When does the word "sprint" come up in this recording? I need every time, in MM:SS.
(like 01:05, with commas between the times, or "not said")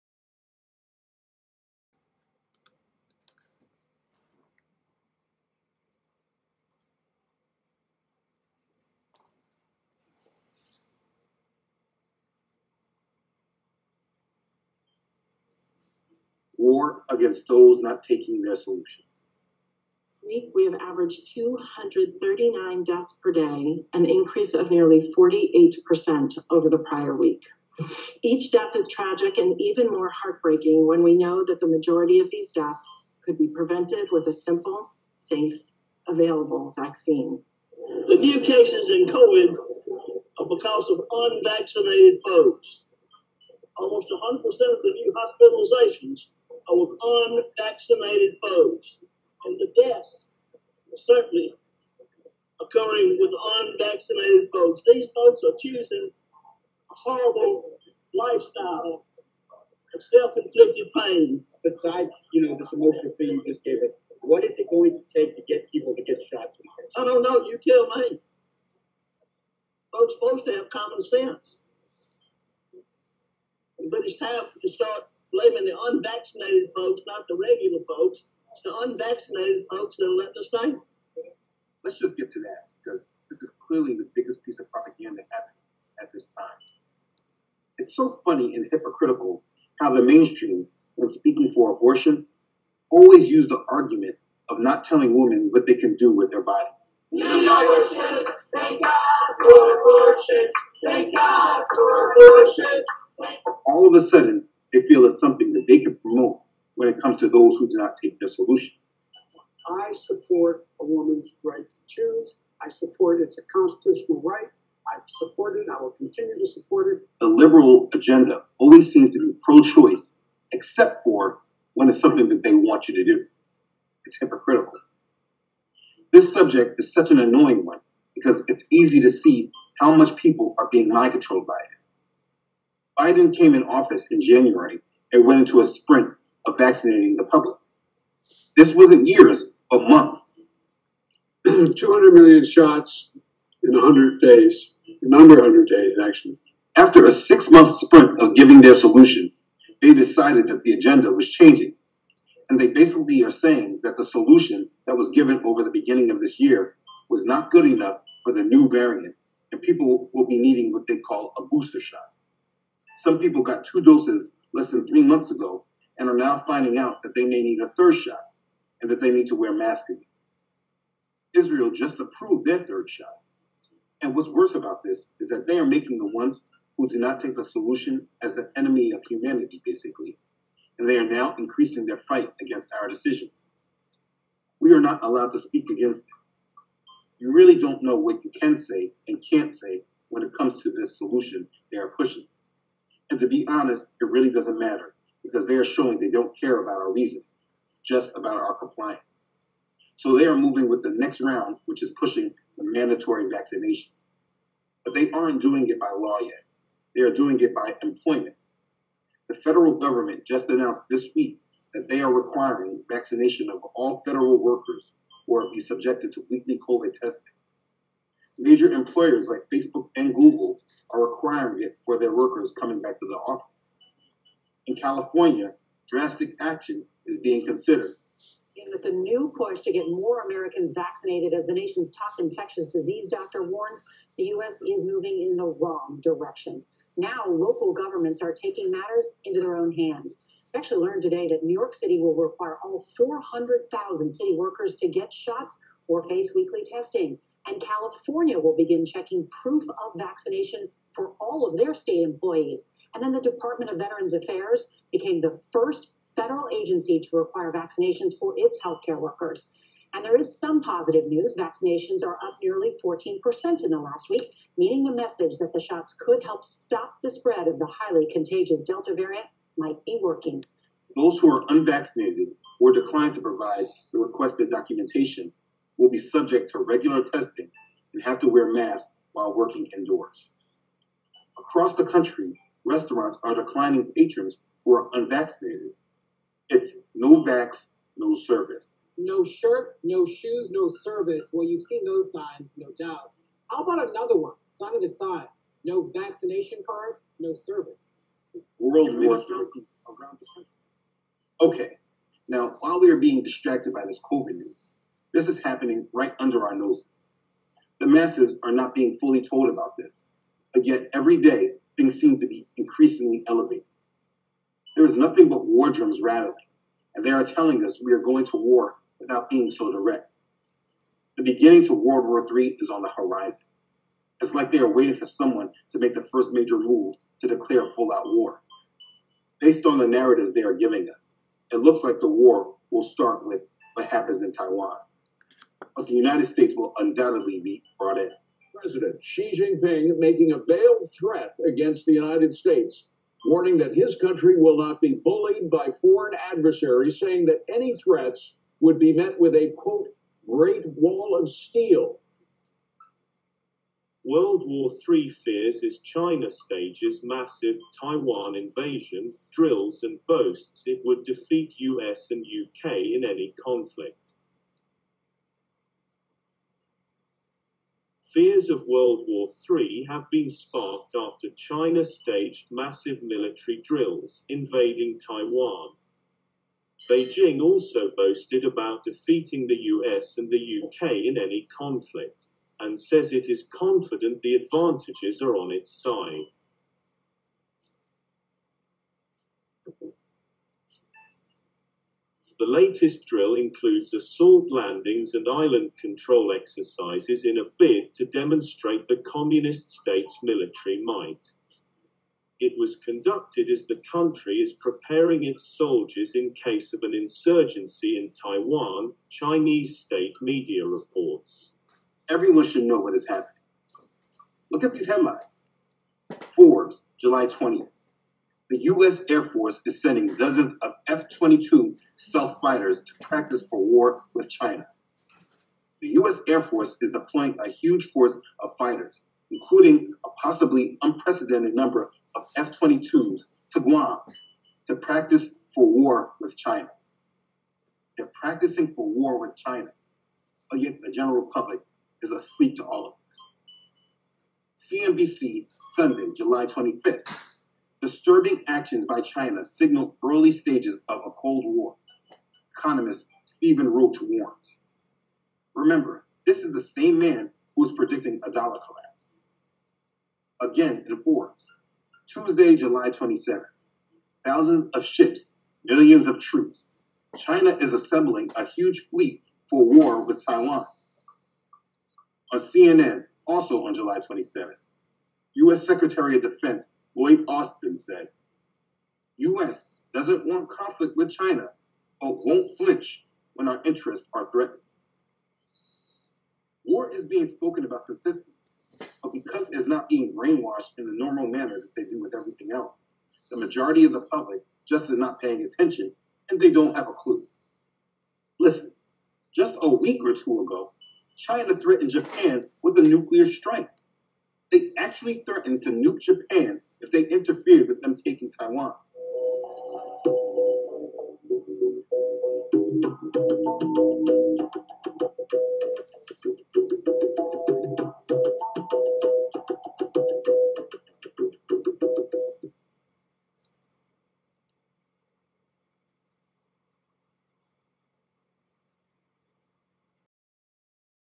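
02:15, 02:27.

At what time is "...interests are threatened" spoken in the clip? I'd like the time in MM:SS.
08:03.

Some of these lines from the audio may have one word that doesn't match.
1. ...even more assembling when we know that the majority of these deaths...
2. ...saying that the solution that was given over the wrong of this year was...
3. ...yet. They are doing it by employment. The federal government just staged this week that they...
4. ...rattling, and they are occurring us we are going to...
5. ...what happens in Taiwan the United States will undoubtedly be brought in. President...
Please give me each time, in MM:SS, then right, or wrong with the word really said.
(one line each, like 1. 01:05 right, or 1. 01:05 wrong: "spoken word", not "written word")
1. 00:29 wrong: "heartbreaking", not "assembling"
2. 02:33 wrong: "beginning", not "wrong"
3. 03:26 wrong: "announced", not "staged"
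4. 05:16 wrong: "telling", not "occurring"
5. 05:33 right.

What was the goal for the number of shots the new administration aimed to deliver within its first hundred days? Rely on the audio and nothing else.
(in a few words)
200 million.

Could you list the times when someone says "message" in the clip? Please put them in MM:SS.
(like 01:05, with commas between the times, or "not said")
04:24.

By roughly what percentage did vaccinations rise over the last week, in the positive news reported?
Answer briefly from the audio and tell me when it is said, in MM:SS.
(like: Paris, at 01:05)
14%, at 04:22.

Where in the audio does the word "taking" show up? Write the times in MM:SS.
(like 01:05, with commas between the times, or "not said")
00:18, 03:58, 08:27.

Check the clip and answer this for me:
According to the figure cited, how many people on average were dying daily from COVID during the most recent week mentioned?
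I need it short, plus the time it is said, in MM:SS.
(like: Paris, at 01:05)
239, at 00:21.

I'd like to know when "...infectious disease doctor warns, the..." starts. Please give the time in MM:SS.
03:52.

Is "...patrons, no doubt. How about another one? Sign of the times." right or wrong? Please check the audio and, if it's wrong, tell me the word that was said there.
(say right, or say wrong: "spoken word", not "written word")
wrong: "signs", not "patrons".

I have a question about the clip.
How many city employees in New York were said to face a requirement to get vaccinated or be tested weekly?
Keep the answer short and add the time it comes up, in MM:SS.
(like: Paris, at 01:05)
400,000, at 04:02.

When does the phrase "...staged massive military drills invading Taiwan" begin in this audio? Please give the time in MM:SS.
06:11.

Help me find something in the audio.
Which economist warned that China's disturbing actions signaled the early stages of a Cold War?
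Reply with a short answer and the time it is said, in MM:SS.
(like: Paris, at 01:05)
Stephen Roach, at 07:33.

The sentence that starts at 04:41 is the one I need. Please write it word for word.
Across the country, restaurants are declining patrons who are unvaccinated.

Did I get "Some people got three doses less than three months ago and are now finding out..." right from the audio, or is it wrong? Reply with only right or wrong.
wrong.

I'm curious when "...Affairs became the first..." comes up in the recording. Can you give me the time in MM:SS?
04:14.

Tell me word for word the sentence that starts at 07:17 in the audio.
They're practicing for war with China, but yet the general public is asleep to all of this.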